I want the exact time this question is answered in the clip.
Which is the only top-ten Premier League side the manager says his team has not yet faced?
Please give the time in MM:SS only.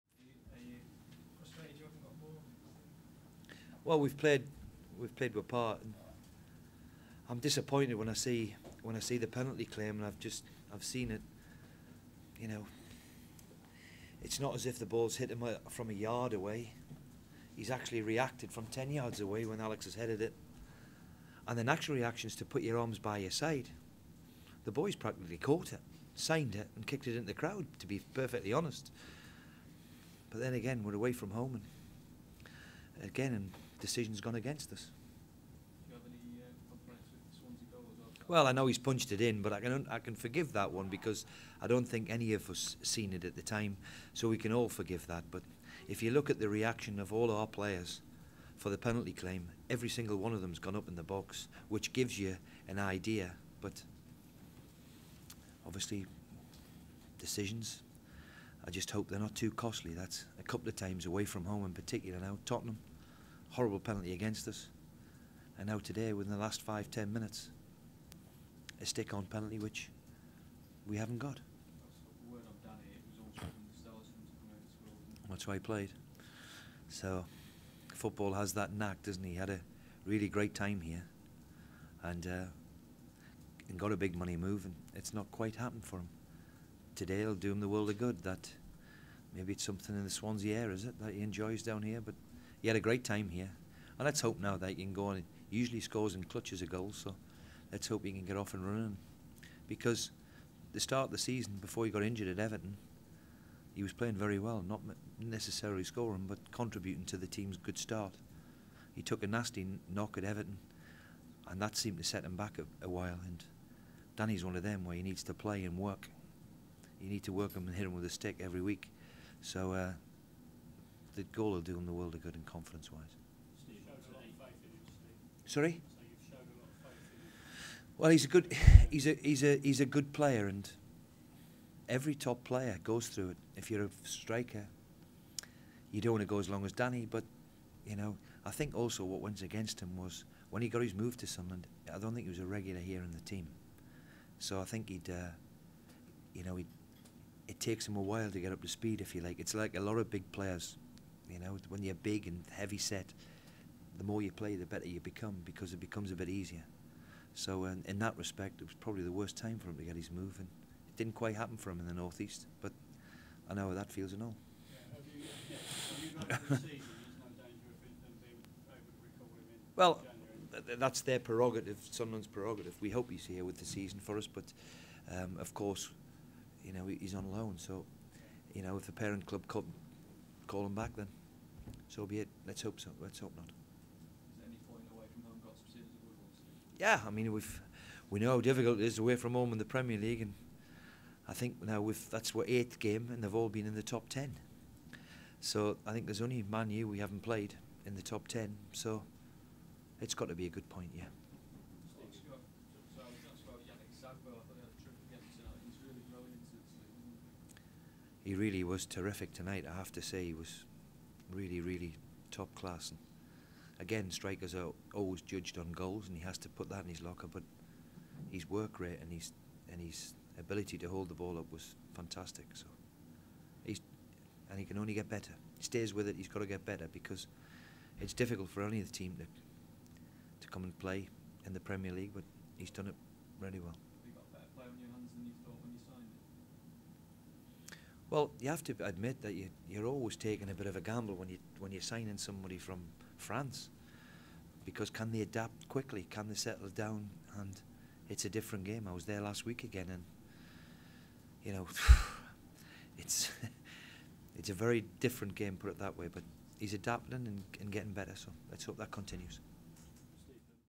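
03:16.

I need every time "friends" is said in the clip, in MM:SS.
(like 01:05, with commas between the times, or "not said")
not said.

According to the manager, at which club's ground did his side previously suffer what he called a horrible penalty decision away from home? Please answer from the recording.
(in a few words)
Tottenham.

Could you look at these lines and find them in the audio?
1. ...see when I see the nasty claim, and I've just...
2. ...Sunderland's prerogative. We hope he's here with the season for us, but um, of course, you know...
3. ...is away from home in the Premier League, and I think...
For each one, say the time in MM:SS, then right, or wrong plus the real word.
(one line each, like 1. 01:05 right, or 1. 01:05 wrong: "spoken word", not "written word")
1. 00:08 wrong: "penalty", not "nasty"
2. 02:51 right
3. 03:08 right.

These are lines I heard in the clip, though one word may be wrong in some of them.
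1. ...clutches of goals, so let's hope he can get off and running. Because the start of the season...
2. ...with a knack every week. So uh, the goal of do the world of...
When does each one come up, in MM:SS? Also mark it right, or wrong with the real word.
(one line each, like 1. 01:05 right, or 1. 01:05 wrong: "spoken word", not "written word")
1. 01:36 right
2. 01:57 wrong: "stick", not "knack".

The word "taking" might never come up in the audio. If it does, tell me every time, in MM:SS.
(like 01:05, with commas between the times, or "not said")
04:00.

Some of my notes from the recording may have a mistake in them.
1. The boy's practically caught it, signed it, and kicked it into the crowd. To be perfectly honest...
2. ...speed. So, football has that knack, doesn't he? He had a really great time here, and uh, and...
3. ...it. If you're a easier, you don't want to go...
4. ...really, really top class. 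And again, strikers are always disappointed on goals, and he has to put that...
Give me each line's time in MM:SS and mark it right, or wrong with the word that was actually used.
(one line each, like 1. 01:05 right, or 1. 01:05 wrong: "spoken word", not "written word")
1. 00:24 right
2. 01:15 wrong: "played", not "speed"
3. 02:13 wrong: "striker", not "easier"
4. 03:31 wrong: "judged", not "disappointed".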